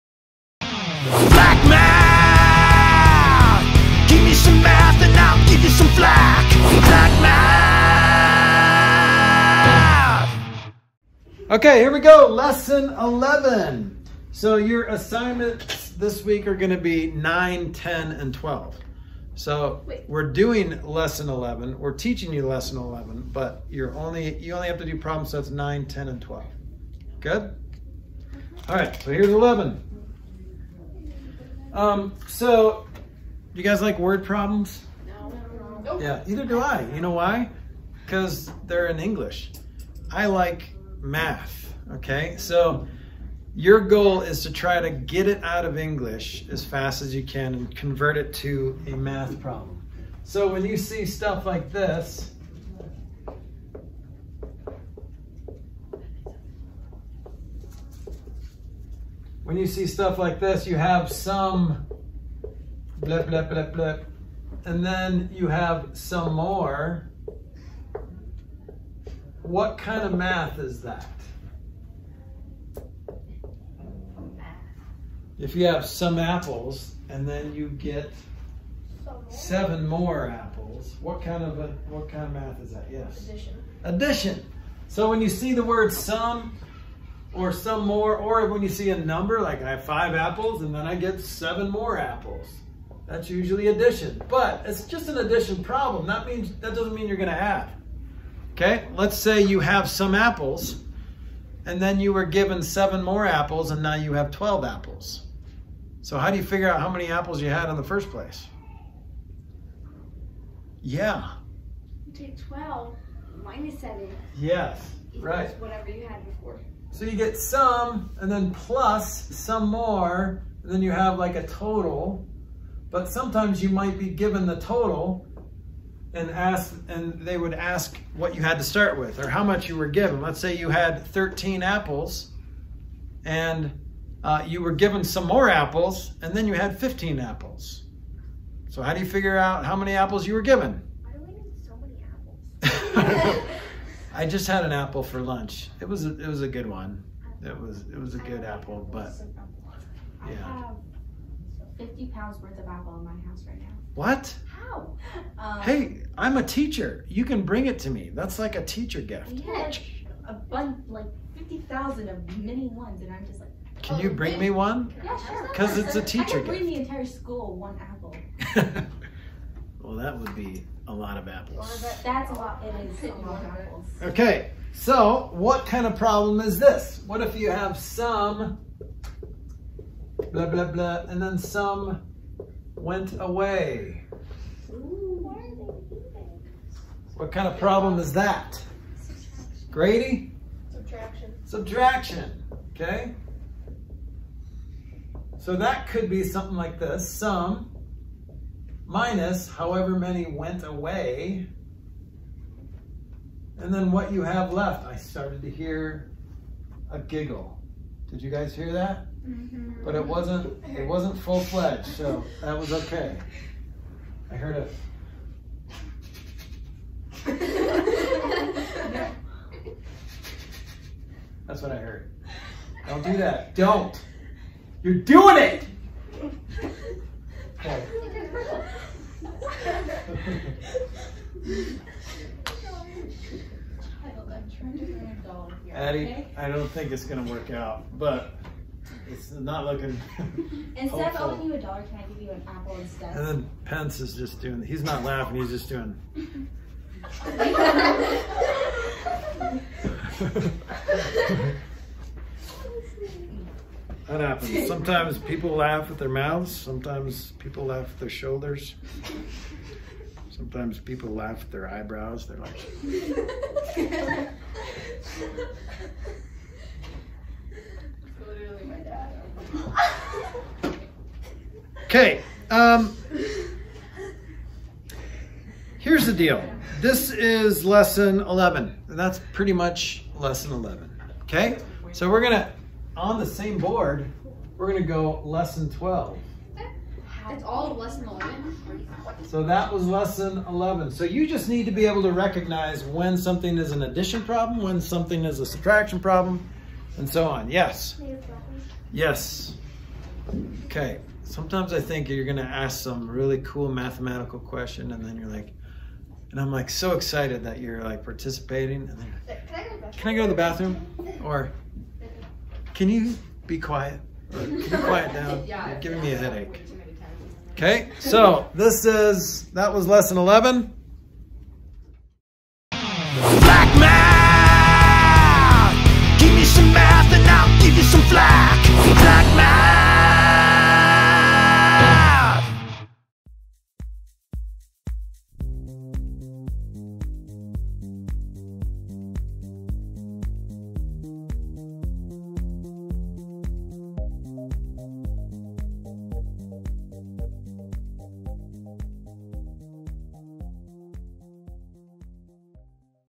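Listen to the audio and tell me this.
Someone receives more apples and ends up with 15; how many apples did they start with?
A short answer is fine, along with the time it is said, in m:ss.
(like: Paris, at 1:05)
13, at 2:11.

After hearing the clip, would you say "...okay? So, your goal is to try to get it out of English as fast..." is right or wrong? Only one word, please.
right.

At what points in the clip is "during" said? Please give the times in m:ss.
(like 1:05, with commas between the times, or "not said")
not said.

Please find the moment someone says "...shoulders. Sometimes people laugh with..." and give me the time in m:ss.
4:18.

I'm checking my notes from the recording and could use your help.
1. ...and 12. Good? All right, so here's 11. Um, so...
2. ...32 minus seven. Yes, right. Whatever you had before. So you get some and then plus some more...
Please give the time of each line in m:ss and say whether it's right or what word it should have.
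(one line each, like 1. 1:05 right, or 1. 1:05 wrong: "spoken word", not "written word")
1. 0:26 right
2. 1:52 wrong: "12", not "32".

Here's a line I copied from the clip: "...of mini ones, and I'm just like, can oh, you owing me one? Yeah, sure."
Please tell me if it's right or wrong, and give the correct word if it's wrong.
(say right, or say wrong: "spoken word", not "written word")
wrong: "bring", not "owing".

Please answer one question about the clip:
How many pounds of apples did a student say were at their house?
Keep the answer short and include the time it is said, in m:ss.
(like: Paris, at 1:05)
50, at 2:31.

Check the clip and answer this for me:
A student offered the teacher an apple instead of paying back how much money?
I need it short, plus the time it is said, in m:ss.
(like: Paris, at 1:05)
a dollar, at 4:01.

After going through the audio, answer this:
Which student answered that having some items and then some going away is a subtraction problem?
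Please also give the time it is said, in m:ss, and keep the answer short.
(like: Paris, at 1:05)
Grady, at 3:09.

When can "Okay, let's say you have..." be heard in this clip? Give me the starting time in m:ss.
1:38.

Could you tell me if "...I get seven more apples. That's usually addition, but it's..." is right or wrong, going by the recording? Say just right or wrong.
right.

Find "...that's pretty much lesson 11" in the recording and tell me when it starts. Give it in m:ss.
4:38.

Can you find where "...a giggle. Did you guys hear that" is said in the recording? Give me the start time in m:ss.
3:26.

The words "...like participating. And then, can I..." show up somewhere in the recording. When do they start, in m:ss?
5:07.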